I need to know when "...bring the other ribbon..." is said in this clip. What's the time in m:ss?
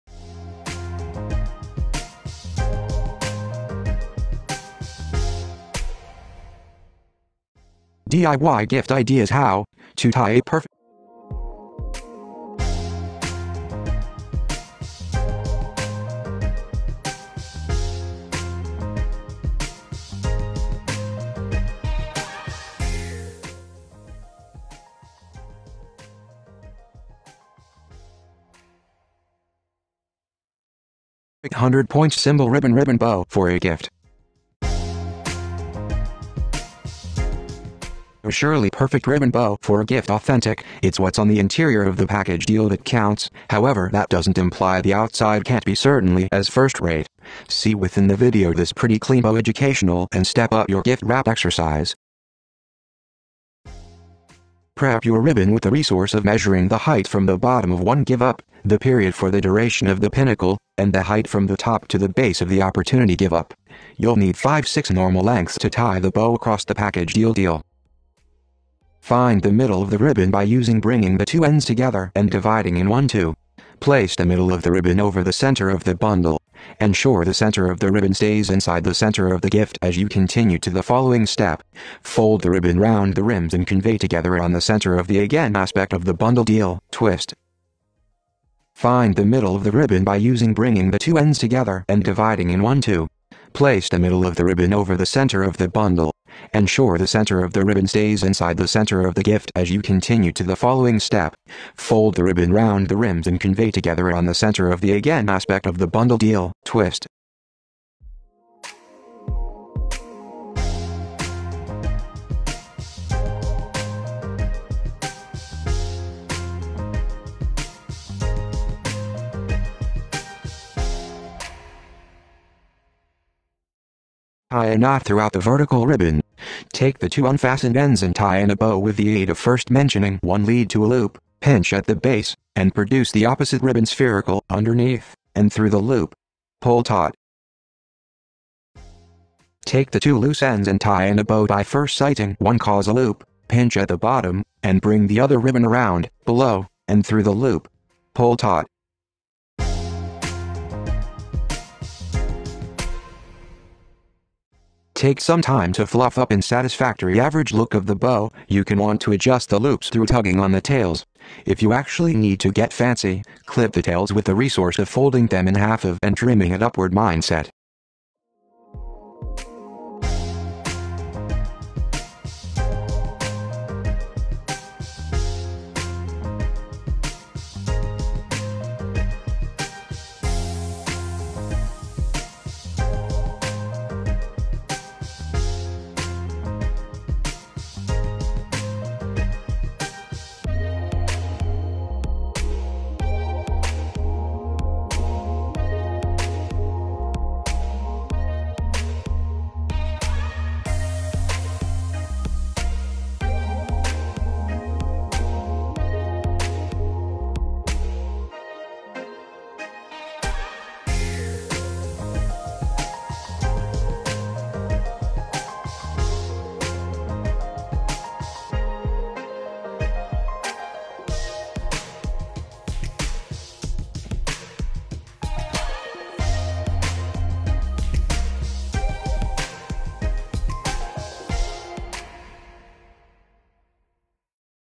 2:24.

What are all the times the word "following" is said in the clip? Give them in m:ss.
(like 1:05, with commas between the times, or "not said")
1:20, 1:40.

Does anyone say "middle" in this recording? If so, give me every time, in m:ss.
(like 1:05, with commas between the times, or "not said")
1:09, 1:14, 1:29, 1:33.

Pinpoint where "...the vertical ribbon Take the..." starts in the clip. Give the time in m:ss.
2:05.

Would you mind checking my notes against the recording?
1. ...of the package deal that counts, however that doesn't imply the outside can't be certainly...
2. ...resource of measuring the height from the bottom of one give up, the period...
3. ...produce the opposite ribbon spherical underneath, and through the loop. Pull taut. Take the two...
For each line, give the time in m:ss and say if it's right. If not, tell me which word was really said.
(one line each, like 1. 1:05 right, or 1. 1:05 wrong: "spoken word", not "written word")
1. 0:41 right
2. 0:55 right
3. 2:12 right.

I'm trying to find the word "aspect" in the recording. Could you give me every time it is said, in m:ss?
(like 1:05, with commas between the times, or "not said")
1:25, 1:45.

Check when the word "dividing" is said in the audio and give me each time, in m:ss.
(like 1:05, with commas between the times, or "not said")
1:12, 1:32.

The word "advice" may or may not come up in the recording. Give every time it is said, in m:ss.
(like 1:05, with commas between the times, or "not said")
not said.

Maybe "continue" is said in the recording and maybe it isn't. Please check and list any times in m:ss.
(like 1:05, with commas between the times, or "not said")
1:20, 1:39.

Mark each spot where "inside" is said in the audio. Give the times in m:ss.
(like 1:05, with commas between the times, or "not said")
1:18, 1:38.